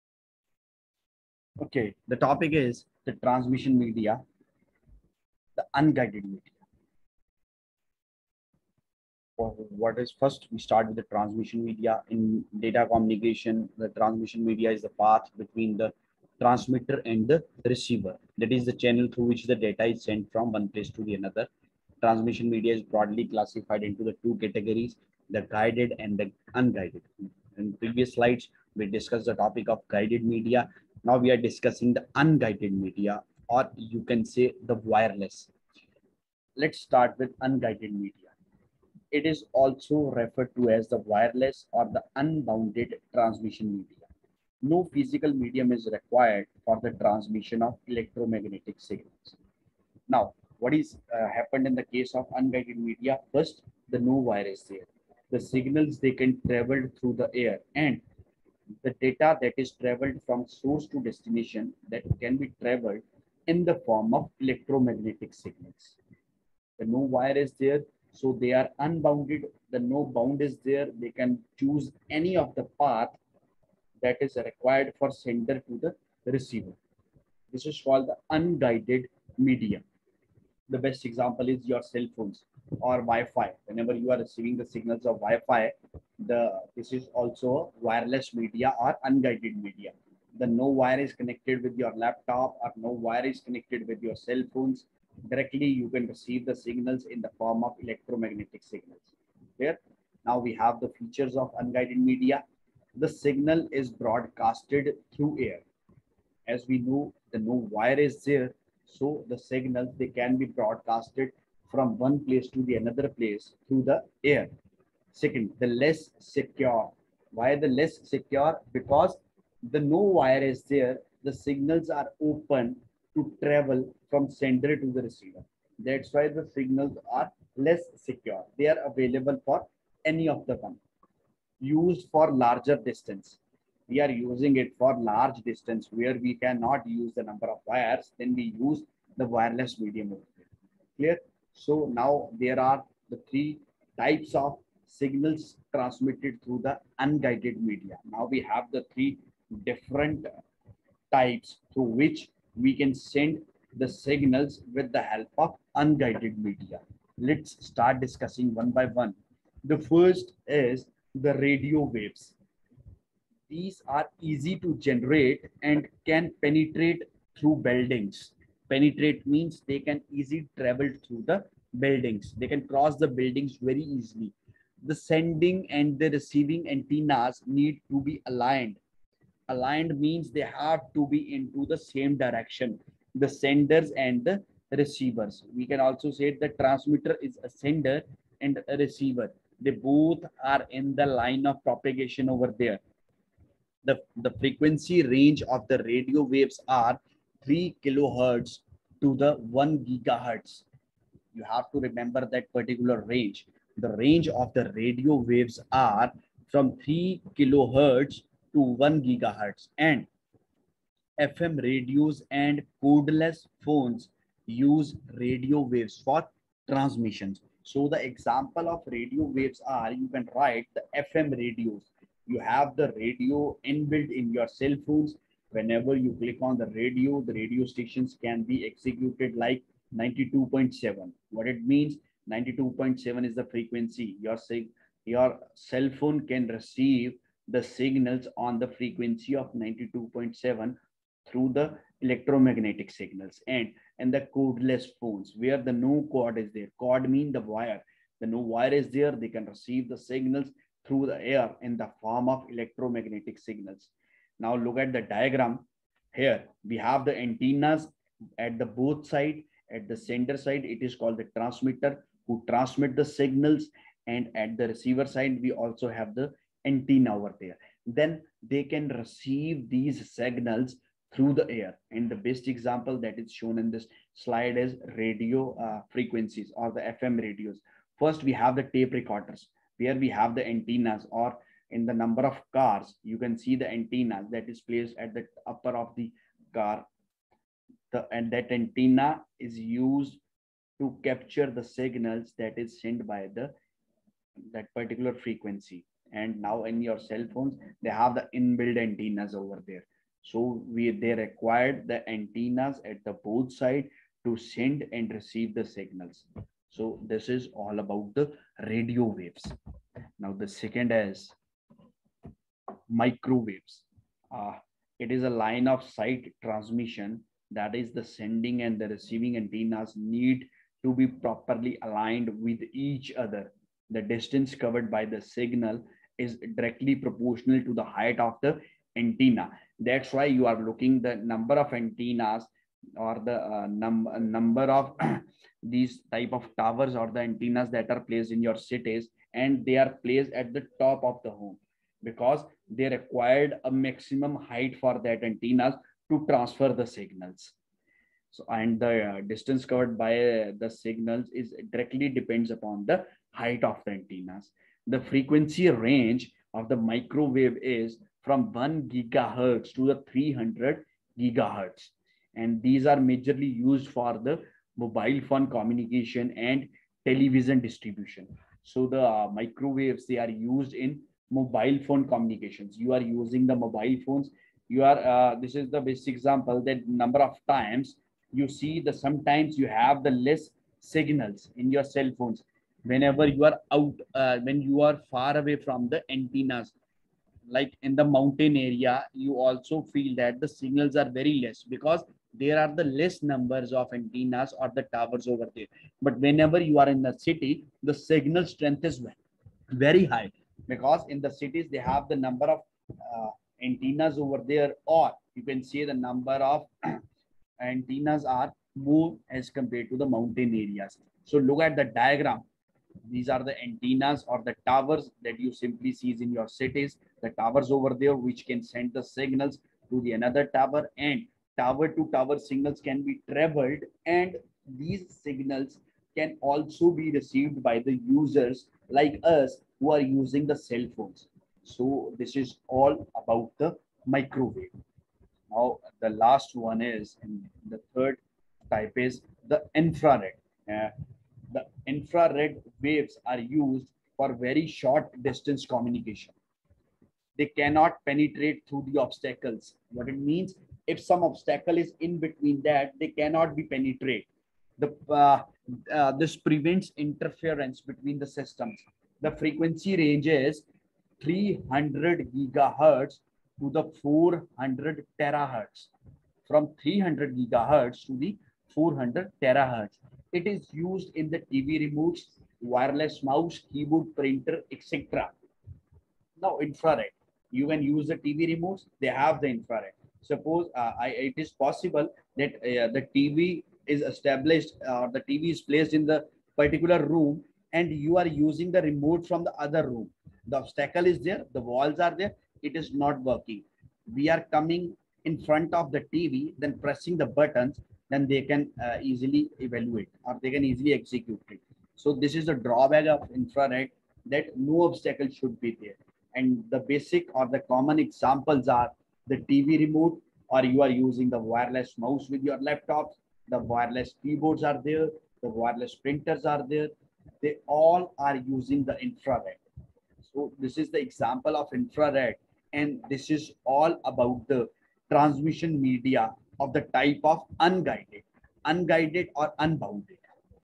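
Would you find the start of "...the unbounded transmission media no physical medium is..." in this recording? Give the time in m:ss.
0:41.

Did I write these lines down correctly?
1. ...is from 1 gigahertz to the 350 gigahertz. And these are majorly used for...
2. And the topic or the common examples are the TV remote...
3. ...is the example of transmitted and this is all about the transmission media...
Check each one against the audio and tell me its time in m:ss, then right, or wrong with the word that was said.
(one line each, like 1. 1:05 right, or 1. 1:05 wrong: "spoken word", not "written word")
1. 5:57 wrong: "300", not "350"
2. 8:26 wrong: "basic", not "topic"
3. 8:40 wrong: "infrared", not "transmitted".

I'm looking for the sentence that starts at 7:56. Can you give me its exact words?
Now infrared, you can use the TV remotes, they have the infrared.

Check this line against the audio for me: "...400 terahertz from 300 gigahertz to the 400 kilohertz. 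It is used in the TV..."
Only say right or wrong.
wrong.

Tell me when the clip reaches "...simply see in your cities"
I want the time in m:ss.
6:55.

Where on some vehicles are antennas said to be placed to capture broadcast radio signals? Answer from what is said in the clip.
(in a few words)
upper of the car.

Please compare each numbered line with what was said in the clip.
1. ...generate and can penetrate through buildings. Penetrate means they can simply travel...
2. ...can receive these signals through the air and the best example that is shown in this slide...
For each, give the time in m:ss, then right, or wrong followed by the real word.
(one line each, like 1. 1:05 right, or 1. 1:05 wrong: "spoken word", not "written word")
1. 2:44 wrong: "easily", not "simply"
2. 4:28 right.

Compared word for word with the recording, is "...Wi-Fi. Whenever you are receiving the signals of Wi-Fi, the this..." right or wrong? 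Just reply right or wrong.
right.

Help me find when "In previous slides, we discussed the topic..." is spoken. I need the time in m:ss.
0:27.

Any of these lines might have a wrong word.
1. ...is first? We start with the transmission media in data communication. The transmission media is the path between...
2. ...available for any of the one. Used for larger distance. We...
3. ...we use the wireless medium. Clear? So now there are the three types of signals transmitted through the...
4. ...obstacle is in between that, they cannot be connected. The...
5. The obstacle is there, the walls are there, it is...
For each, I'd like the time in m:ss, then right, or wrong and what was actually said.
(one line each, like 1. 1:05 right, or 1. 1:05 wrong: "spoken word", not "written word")
1. 0:09 right
2. 2:08 right
3. 2:18 right
4. 7:31 wrong: "penetrated", not "connected"
5. 8:10 right.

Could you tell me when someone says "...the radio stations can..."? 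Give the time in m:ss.
3:47.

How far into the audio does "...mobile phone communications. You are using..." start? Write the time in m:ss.
6:11.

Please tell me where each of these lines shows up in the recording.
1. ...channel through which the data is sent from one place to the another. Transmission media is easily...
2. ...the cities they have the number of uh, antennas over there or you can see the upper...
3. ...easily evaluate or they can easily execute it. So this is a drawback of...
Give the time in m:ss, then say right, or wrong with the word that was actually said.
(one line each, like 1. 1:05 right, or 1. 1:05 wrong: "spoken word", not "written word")
1. 0:18 wrong: "broadly", not "easily"
2. 6:41 wrong: "number", not "upper"
3. 8:19 right.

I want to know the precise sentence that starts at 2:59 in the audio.
Aligned means they have to be into the same direction, the senders and the receivers.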